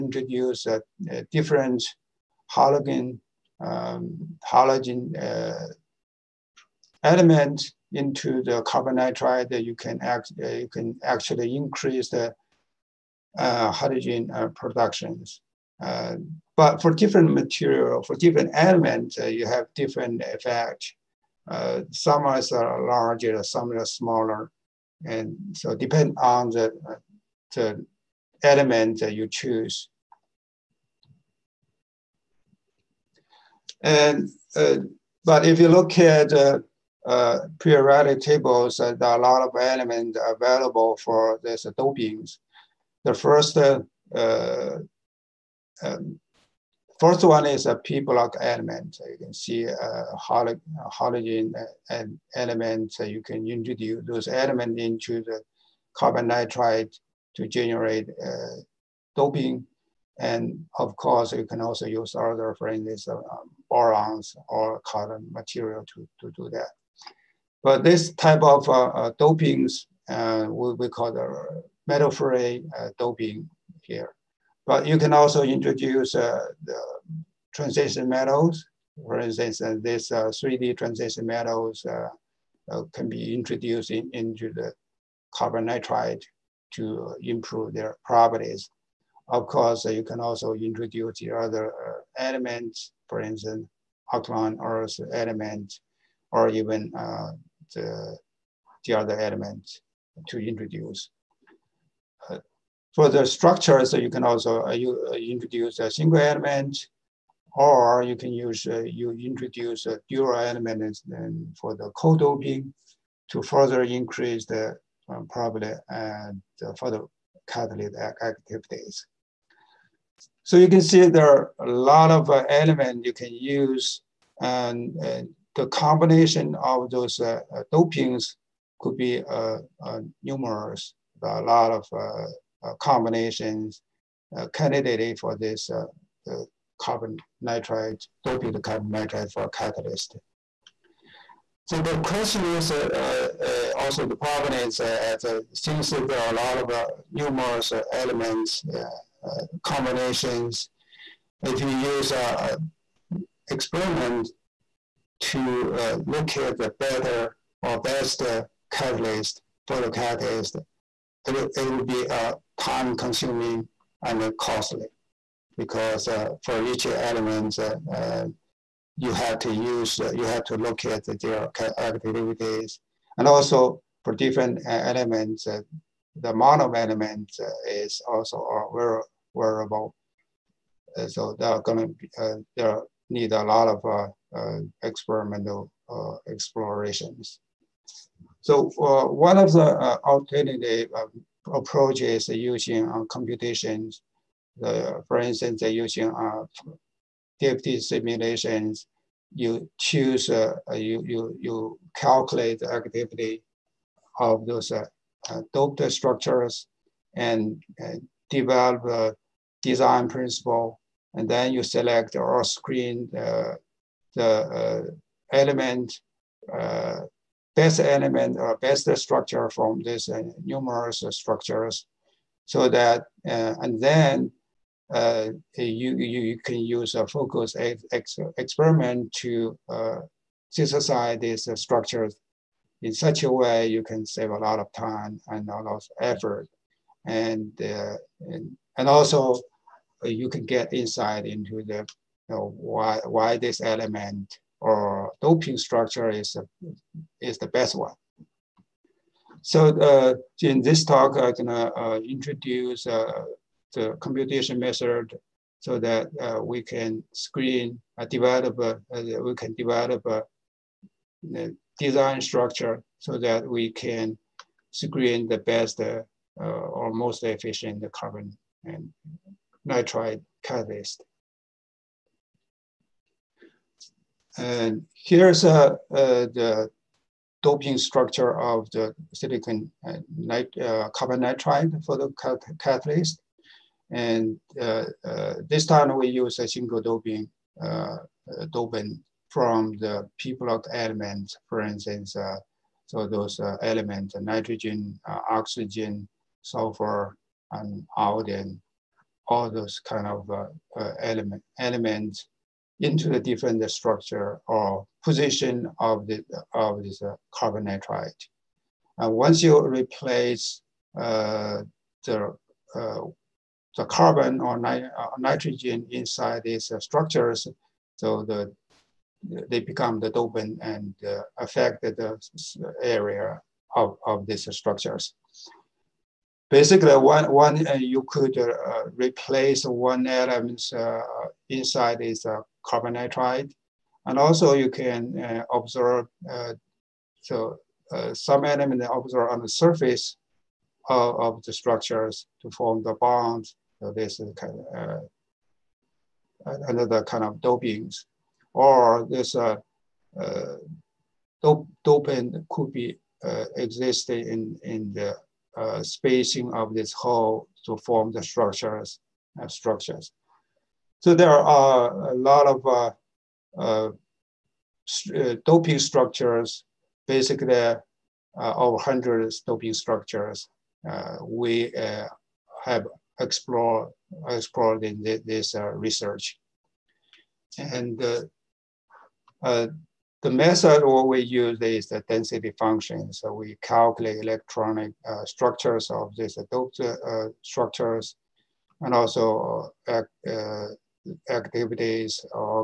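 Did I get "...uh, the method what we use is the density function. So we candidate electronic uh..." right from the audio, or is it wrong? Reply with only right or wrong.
wrong.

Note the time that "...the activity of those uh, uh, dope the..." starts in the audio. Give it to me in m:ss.
3:22.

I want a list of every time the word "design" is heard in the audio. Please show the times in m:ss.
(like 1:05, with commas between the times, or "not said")
3:29, 4:21.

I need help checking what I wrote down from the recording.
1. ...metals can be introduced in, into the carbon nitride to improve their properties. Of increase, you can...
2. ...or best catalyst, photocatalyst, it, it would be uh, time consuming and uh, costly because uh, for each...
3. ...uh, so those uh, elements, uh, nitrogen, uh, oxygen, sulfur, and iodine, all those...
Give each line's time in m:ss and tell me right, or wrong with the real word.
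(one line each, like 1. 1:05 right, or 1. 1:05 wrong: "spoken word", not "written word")
1. 1:21 wrong: "course", not "increase"
2. 2:37 right
3. 4:52 right.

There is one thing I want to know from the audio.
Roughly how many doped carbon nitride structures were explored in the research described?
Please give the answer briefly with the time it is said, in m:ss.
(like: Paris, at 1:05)
over 100, at 6:08.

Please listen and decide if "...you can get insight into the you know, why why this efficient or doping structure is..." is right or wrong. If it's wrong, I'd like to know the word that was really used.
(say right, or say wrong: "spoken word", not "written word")
wrong: "element", not "efficient".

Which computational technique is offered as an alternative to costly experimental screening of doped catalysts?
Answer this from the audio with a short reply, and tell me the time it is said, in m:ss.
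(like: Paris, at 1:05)
DFT simulations, at 3:17.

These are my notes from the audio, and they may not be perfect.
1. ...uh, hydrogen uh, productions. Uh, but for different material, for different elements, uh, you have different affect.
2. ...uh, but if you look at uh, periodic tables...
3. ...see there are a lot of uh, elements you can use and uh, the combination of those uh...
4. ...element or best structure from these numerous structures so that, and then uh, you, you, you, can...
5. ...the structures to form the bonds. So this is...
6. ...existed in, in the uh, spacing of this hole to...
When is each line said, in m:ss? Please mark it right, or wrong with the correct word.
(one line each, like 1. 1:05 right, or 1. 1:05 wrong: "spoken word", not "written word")
1. 0:13 wrong: "effect", not "affect"
2. 0:34 right
3. 2:00 right
4. 3:37 right
5. 5:41 right
6. 5:53 right.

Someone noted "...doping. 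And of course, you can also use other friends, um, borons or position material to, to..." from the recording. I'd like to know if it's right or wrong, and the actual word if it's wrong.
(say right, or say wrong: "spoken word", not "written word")
wrong: "carbon", not "position".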